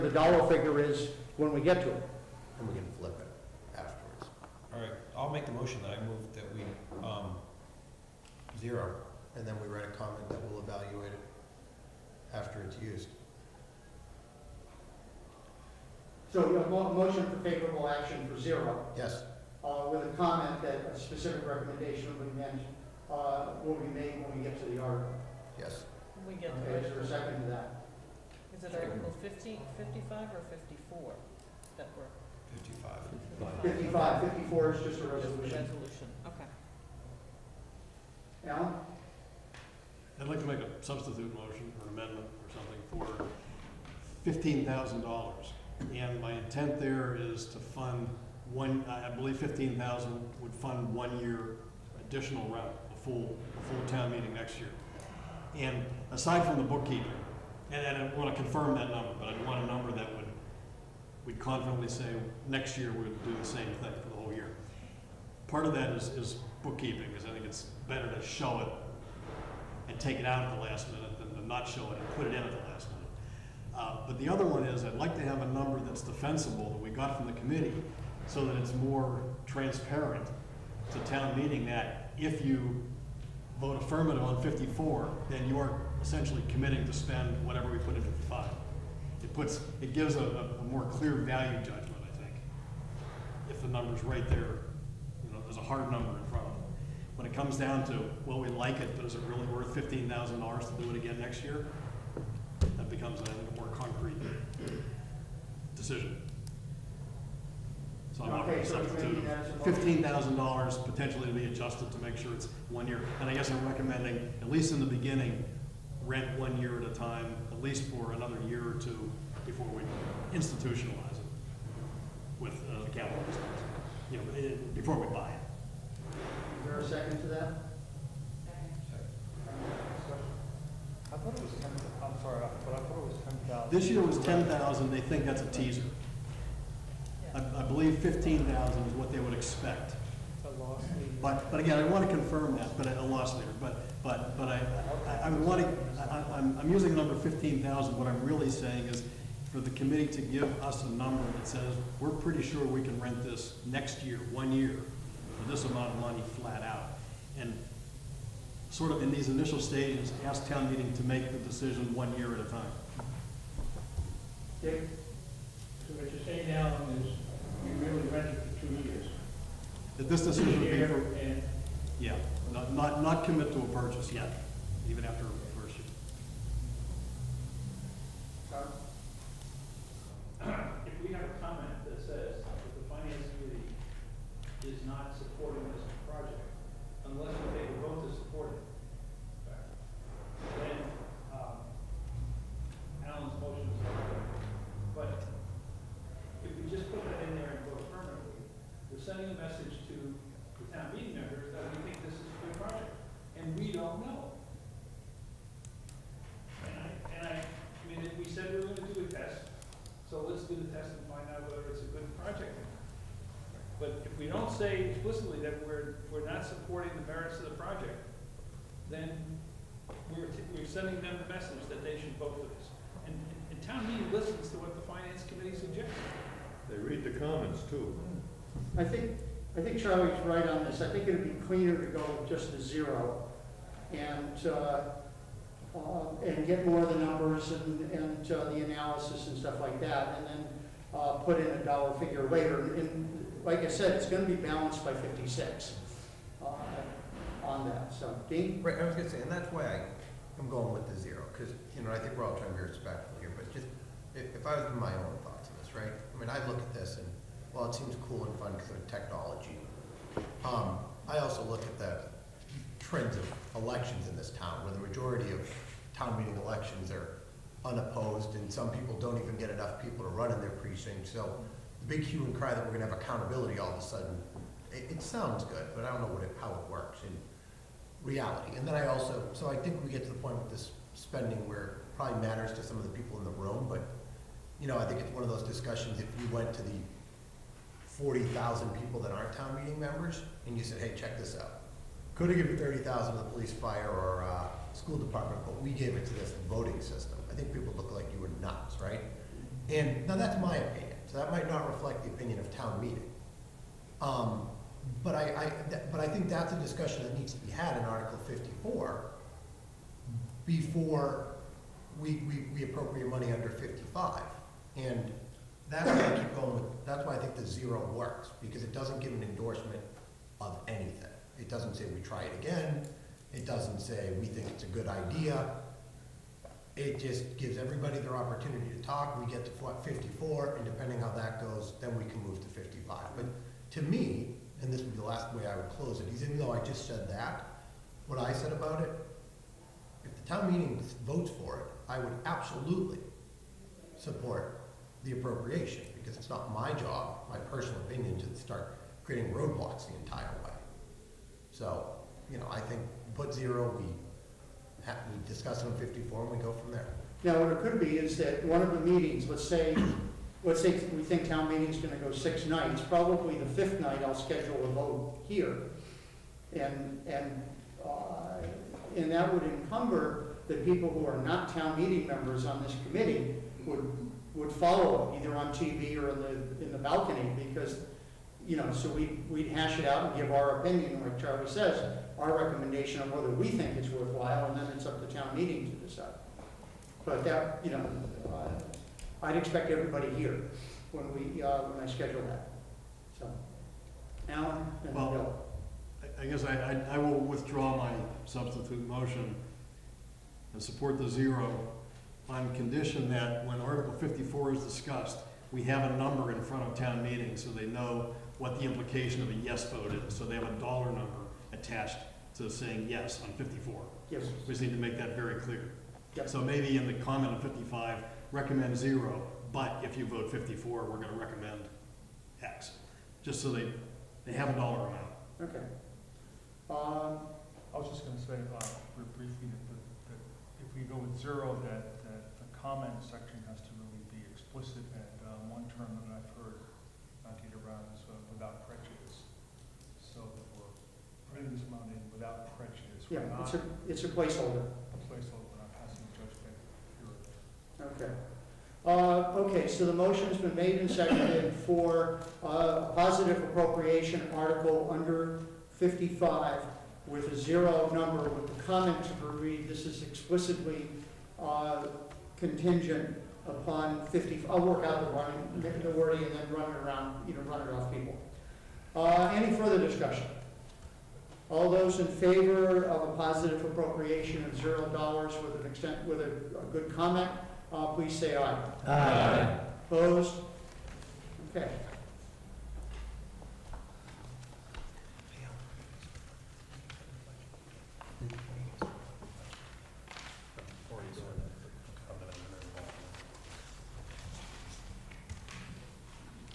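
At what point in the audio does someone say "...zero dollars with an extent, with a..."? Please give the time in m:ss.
7:54.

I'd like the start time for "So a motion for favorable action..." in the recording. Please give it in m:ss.
0:16.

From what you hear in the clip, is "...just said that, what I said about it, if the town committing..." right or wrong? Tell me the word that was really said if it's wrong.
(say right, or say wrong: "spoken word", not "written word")
wrong: "meeting", not "committing".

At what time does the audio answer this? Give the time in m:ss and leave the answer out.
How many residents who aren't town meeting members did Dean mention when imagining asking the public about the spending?
4:47.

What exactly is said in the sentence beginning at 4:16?
I mean, I look at this and well, it seems cool and fun because of technology.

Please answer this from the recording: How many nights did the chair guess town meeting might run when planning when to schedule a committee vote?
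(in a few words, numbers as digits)
6.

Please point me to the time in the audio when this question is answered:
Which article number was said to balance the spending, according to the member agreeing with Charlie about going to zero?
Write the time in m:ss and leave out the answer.
4:04.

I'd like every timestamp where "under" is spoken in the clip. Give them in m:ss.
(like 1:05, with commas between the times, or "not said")
5:13, 7:34.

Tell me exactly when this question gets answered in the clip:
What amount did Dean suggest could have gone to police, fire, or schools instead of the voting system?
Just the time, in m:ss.
4:52.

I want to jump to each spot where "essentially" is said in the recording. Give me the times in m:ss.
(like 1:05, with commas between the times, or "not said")
1:26.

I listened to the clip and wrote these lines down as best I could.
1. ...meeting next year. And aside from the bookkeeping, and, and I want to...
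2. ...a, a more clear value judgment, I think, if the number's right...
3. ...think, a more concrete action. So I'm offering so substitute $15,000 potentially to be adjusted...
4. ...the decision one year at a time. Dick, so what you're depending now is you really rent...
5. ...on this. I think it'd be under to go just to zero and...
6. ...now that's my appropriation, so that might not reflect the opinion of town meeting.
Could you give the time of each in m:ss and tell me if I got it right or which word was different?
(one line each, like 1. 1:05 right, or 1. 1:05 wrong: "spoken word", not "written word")
1. 0:54 right
2. 1:30 right
3. 1:43 wrong: "decision", not "action"
4. 2:41 wrong: "saying", not "depending"
5. 3:50 wrong: "cleaner", not "under"
6. 5:00 wrong: "opinion", not "appropriation".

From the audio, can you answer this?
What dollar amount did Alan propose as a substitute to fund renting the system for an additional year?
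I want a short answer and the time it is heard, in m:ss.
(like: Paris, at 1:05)
$15,000, at 0:44.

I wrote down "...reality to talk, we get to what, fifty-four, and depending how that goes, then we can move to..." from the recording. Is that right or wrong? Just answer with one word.
wrong.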